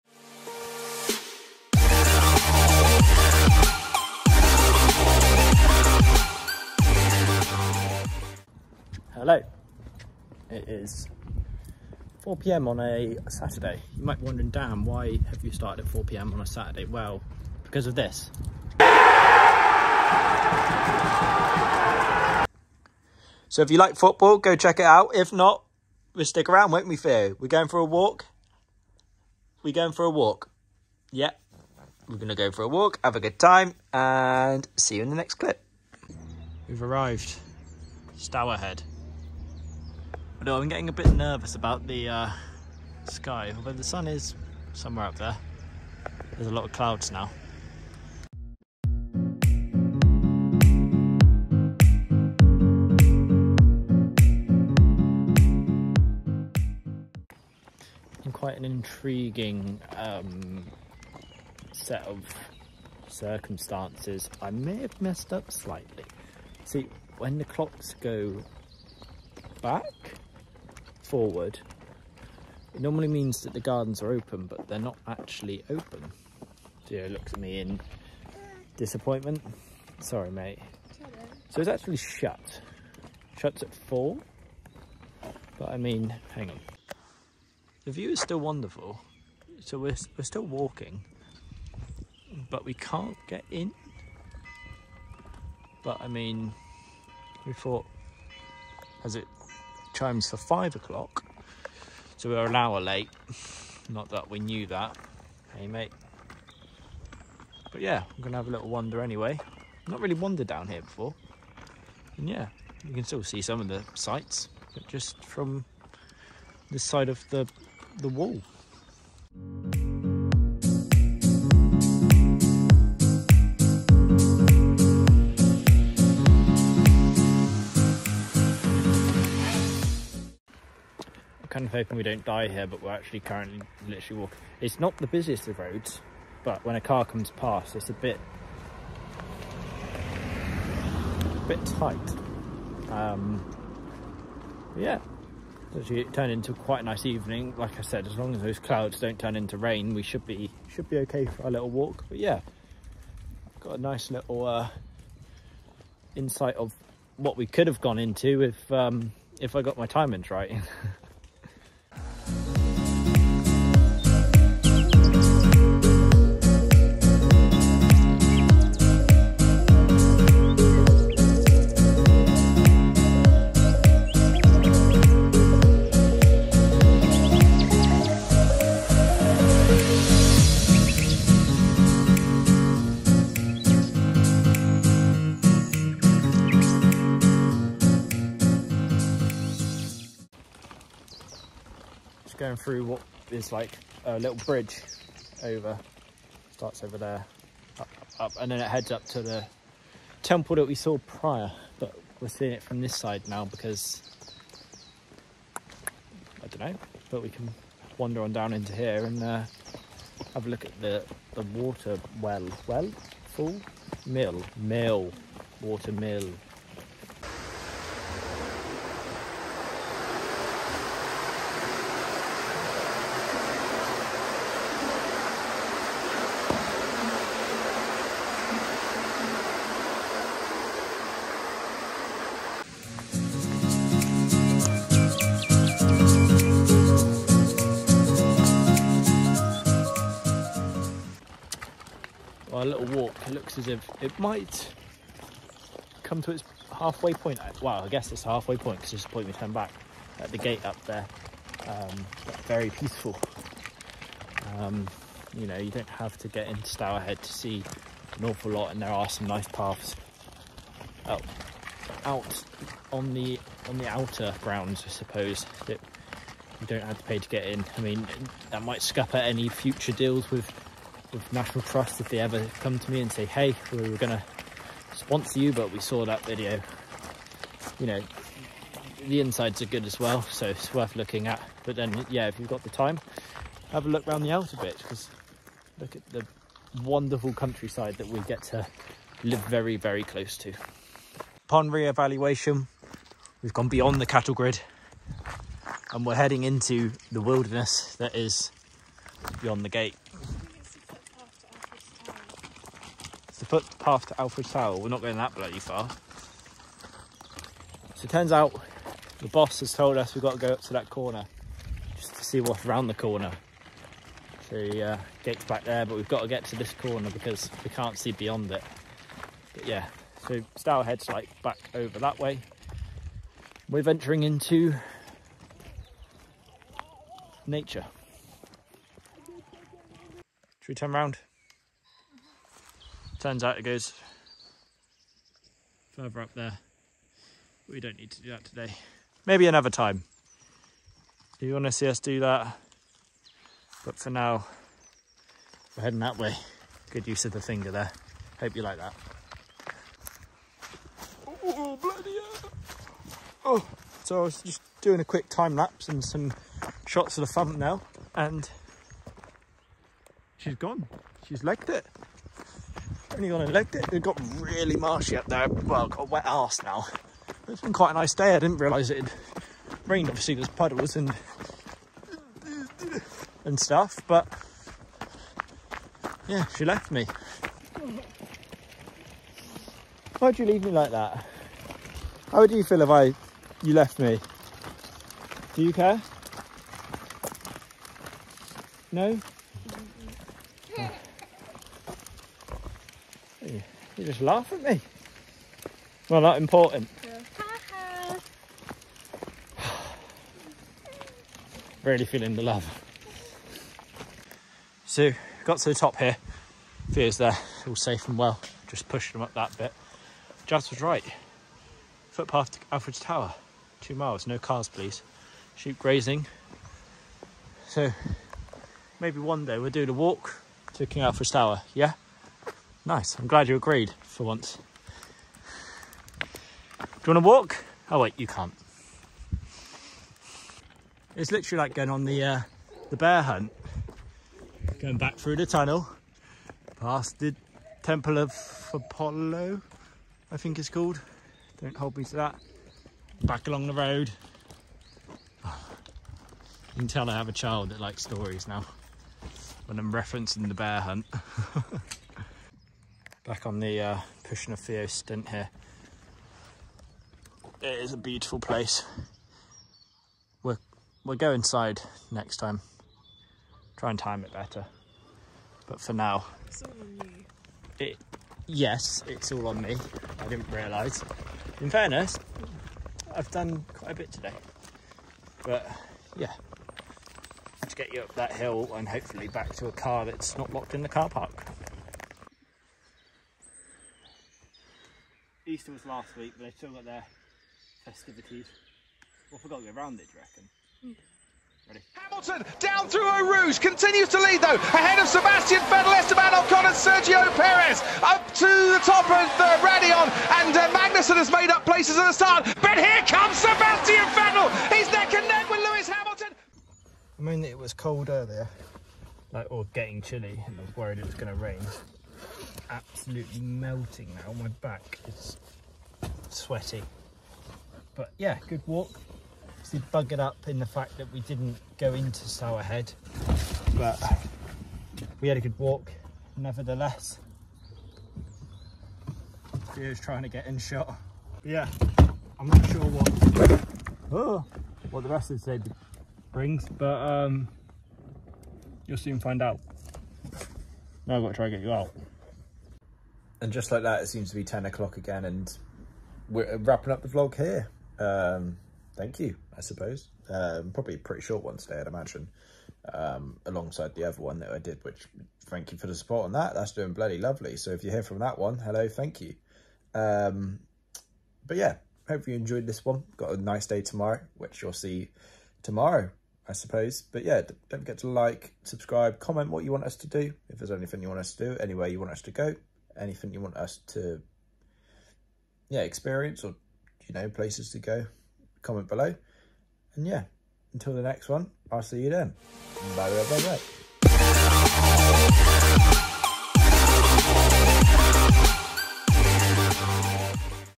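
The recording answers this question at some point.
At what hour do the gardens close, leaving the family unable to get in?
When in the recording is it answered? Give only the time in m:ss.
1:23.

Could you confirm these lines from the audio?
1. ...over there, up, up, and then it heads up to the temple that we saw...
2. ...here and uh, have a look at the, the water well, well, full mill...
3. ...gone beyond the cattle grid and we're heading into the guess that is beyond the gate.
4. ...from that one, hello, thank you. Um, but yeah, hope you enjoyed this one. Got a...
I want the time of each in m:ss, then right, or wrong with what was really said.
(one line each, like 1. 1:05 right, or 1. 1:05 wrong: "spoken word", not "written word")
1. 3:16 right
2. 3:28 right
3. 4:53 wrong: "wilderness", not "guess"
4. 9:18 right.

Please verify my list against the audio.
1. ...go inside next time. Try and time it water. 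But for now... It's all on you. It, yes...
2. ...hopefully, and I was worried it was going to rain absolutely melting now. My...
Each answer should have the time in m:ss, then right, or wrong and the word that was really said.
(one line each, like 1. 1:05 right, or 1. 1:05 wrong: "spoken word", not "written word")
1. 7:41 wrong: "better", not "water"
2. 8:30 wrong: "chilly", not "hopefully".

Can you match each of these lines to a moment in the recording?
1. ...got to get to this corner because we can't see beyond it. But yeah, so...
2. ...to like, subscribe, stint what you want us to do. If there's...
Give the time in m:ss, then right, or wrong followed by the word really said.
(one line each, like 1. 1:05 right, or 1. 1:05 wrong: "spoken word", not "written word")
1. 5:16 right
2. 9:27 wrong: "comment", not "stint".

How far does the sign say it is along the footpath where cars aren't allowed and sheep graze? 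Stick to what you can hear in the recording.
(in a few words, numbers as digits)
2 miles.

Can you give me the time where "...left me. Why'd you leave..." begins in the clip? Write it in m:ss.
6:16.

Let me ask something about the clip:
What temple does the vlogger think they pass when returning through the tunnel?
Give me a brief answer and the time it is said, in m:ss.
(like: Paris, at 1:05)
Temple of Apollo, at 7:17.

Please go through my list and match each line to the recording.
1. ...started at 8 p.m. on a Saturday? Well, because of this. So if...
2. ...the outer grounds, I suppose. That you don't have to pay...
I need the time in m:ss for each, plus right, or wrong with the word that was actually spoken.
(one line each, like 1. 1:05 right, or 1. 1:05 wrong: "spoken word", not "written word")
1. 0:15 wrong: "4", not "8"
2. 4:23 right.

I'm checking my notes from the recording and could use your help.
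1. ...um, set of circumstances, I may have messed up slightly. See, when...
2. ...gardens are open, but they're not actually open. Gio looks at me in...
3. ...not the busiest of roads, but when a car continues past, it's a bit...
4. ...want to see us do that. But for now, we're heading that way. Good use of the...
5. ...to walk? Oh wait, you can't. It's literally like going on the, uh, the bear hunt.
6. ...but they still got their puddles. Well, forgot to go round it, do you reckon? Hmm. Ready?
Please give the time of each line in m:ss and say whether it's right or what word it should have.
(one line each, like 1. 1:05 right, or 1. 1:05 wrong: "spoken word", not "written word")
1. 0:59 right
2. 1:13 right
3. 2:14 wrong: "comes", not "continues"
4. 5:41 right
5. 7:07 right
6. 8:06 wrong: "festivities", not "puddles".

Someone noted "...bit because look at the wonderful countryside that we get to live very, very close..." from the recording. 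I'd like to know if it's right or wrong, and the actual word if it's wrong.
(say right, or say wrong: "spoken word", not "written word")
right.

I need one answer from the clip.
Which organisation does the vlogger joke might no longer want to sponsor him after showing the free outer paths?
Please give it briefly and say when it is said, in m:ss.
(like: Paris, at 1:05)
National Trust, at 4:31.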